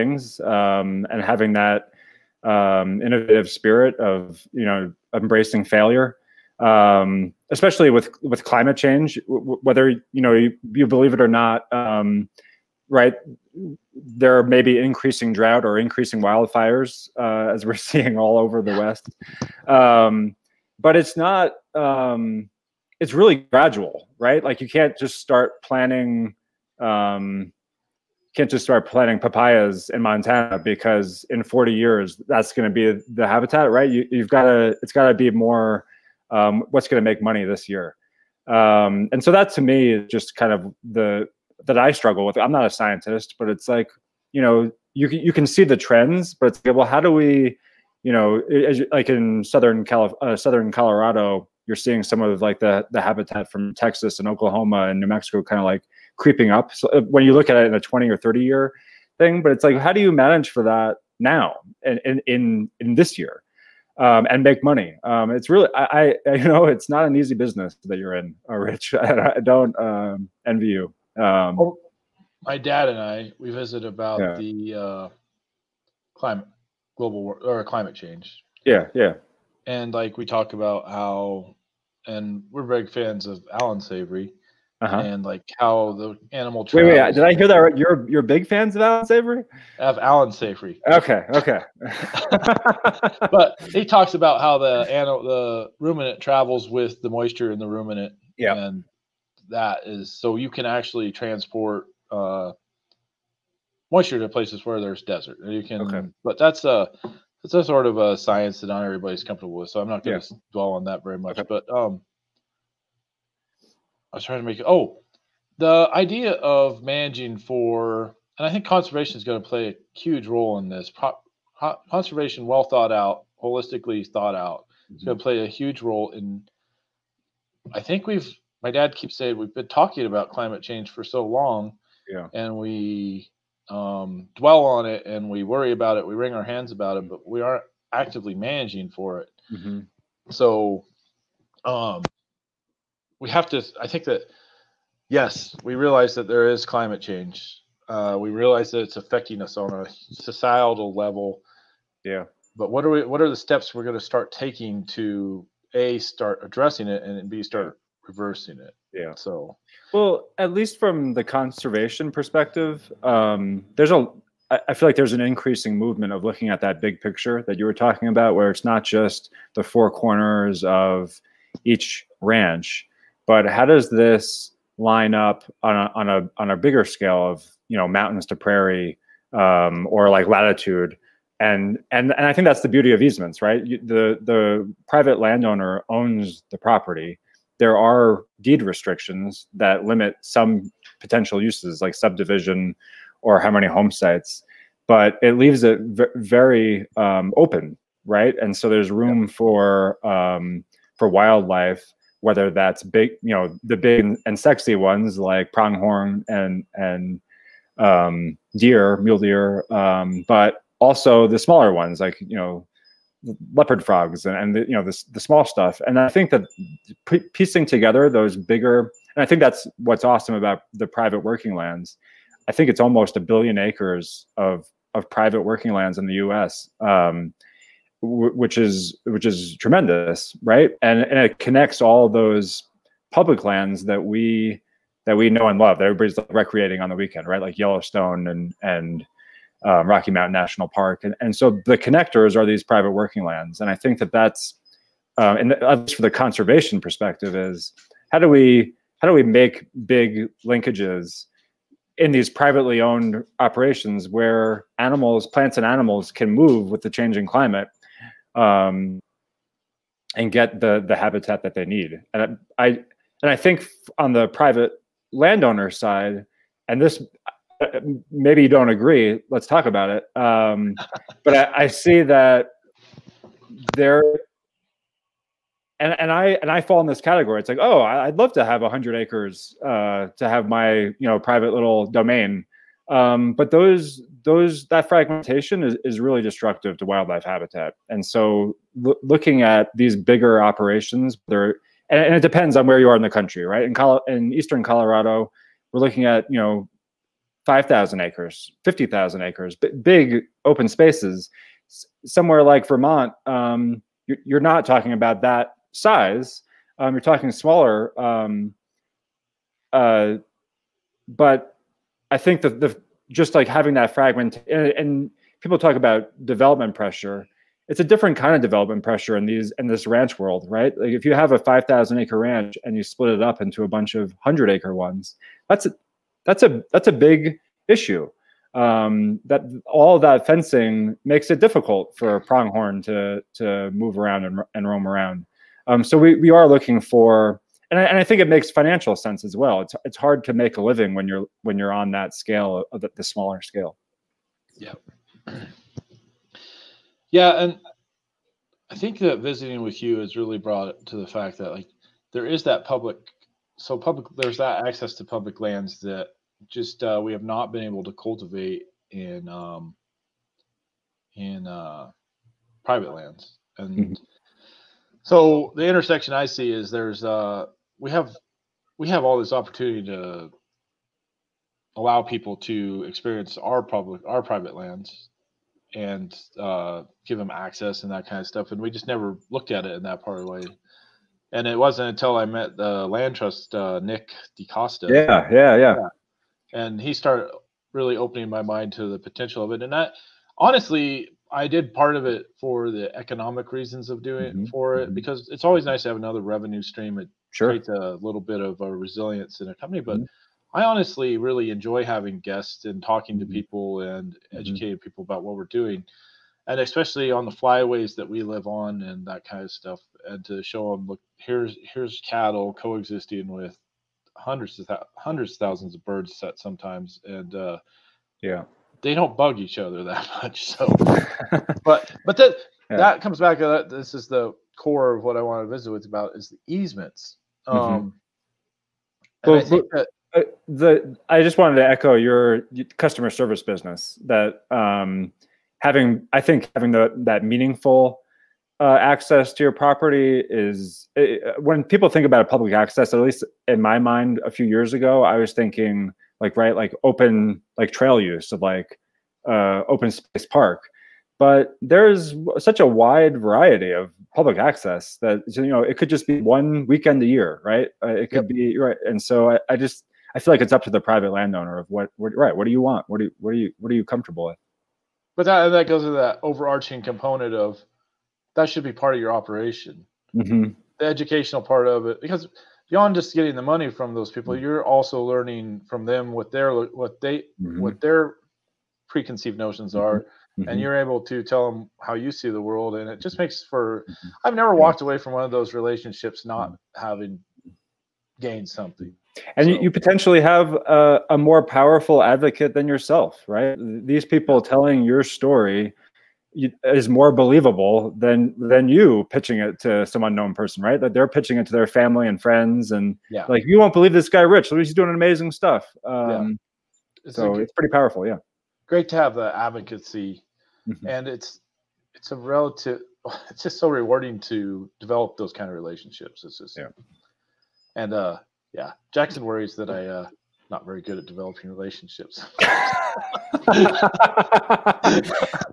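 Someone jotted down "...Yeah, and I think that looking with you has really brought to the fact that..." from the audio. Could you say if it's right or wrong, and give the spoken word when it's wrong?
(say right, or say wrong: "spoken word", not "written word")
wrong: "visiting", not "looking".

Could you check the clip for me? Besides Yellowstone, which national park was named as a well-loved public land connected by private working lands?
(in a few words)
Rocky Mountain National Park.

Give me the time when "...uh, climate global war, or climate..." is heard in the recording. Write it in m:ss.
1:14.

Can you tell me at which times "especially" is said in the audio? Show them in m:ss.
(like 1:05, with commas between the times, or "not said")
0:07, 6:46.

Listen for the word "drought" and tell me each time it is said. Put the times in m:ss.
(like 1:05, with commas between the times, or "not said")
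0:15.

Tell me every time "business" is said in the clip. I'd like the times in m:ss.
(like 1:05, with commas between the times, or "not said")
1:07, 7:13.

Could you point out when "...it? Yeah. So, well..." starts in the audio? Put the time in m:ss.
2:38.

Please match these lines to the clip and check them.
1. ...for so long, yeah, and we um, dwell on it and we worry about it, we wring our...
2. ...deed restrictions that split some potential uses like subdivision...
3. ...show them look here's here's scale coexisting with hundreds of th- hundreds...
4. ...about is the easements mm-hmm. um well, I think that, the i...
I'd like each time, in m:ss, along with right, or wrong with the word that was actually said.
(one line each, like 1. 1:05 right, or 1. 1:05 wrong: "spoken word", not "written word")
1. 2:10 right
2. 3:08 wrong: "limit", not "split"
3. 6:50 wrong: "cattle", not "scale"
4. 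7:05 right.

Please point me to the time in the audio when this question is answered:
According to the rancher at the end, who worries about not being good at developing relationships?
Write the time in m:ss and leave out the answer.
8:38.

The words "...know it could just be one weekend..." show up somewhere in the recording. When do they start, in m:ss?
7:35.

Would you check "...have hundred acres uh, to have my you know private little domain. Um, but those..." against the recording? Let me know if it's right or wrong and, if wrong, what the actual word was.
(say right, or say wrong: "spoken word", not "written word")
right.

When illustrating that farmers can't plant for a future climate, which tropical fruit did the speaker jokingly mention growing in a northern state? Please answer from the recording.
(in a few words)
papayas.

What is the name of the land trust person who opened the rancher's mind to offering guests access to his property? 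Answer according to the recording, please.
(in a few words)
Nick DeCosta.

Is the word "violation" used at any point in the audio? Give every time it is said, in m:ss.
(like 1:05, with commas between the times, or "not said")
not said.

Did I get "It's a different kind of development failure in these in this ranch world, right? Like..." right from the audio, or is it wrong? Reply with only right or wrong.
wrong.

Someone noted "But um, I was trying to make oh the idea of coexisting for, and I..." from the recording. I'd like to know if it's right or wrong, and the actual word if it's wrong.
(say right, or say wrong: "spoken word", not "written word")
wrong: "managing", not "coexisting".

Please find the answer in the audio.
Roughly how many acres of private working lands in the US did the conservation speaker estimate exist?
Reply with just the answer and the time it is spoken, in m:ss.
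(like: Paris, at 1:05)
almost a billion acres, at 3:42.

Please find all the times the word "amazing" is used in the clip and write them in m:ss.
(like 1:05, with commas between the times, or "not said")
8:24.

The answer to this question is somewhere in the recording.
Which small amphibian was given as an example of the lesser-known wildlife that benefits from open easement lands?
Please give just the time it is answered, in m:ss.
3:33.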